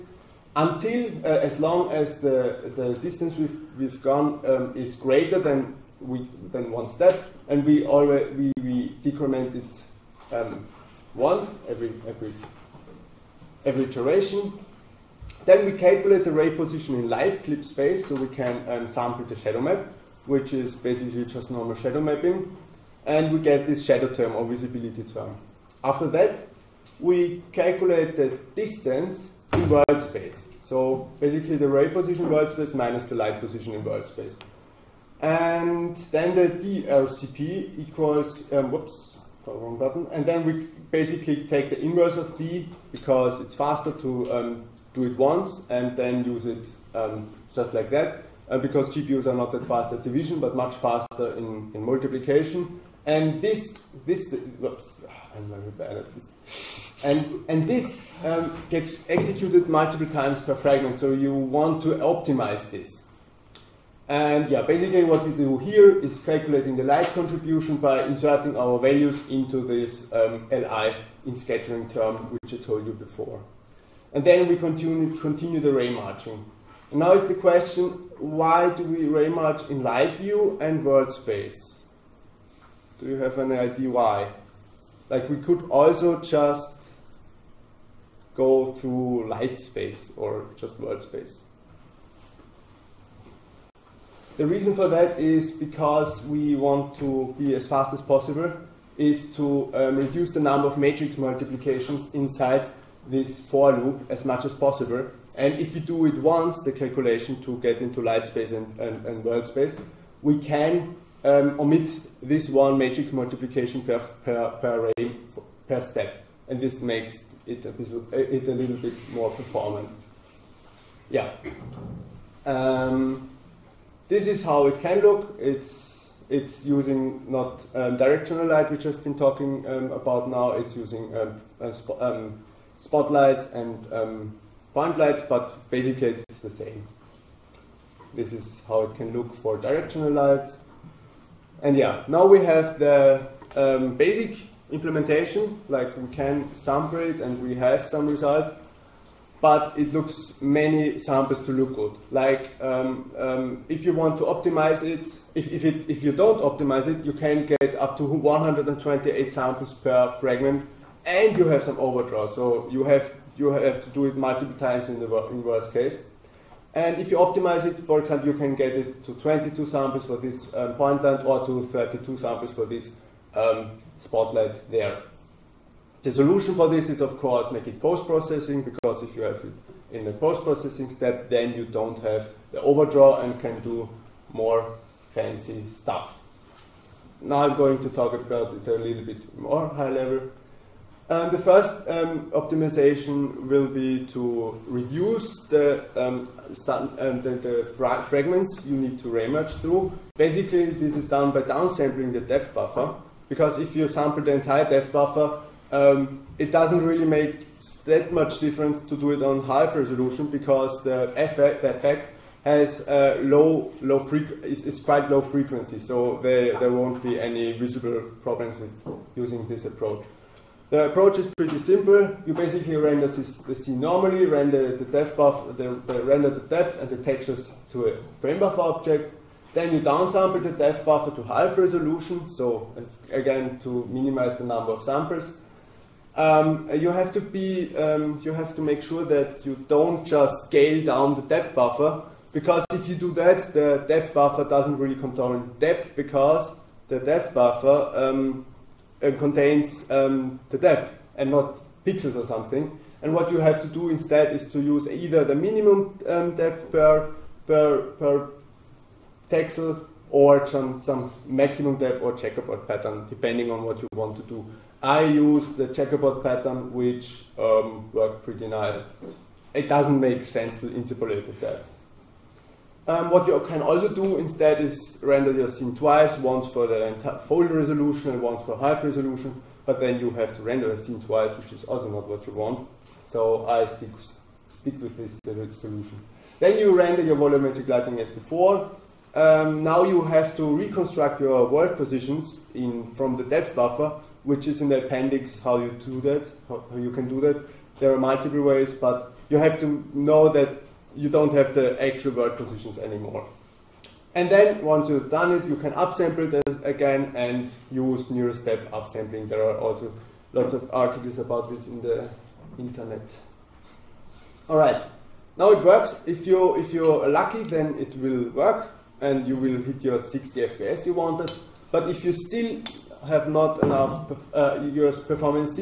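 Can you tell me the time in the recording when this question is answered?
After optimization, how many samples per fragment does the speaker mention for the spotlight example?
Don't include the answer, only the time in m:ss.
2:51.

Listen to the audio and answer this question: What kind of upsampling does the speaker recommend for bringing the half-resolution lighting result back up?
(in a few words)
nearest depth upsampling.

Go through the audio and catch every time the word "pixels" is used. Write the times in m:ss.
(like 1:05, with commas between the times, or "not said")
4:11, 4:19.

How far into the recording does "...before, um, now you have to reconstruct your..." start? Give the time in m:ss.
4:48.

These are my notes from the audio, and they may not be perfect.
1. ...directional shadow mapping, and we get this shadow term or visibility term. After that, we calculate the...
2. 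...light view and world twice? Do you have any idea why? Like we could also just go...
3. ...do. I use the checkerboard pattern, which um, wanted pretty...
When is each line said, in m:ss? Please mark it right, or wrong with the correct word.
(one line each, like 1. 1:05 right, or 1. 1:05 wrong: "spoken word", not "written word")
1. 0:21 wrong: "normal", not "directional"
2. 1:19 wrong: "space", not "twice"
3. 4:24 wrong: "worked", not "wanted".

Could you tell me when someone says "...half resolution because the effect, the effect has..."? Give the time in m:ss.
3:29.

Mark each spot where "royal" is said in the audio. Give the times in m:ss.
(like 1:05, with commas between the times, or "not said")
not said.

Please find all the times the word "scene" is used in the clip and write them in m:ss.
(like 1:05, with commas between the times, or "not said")
3:43, 4:35, 4:40.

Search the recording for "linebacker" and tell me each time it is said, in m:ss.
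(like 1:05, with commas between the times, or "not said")
not said.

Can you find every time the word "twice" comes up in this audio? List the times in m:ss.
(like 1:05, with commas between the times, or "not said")
4:35, 4:41.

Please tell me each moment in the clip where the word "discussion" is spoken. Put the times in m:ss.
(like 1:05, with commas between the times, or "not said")
not said.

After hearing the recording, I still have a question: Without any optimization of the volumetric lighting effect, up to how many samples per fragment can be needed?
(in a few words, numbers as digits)
128.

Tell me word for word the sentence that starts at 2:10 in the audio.
It's using um, um, sp um, spotlights and point lights, but basically it's the same.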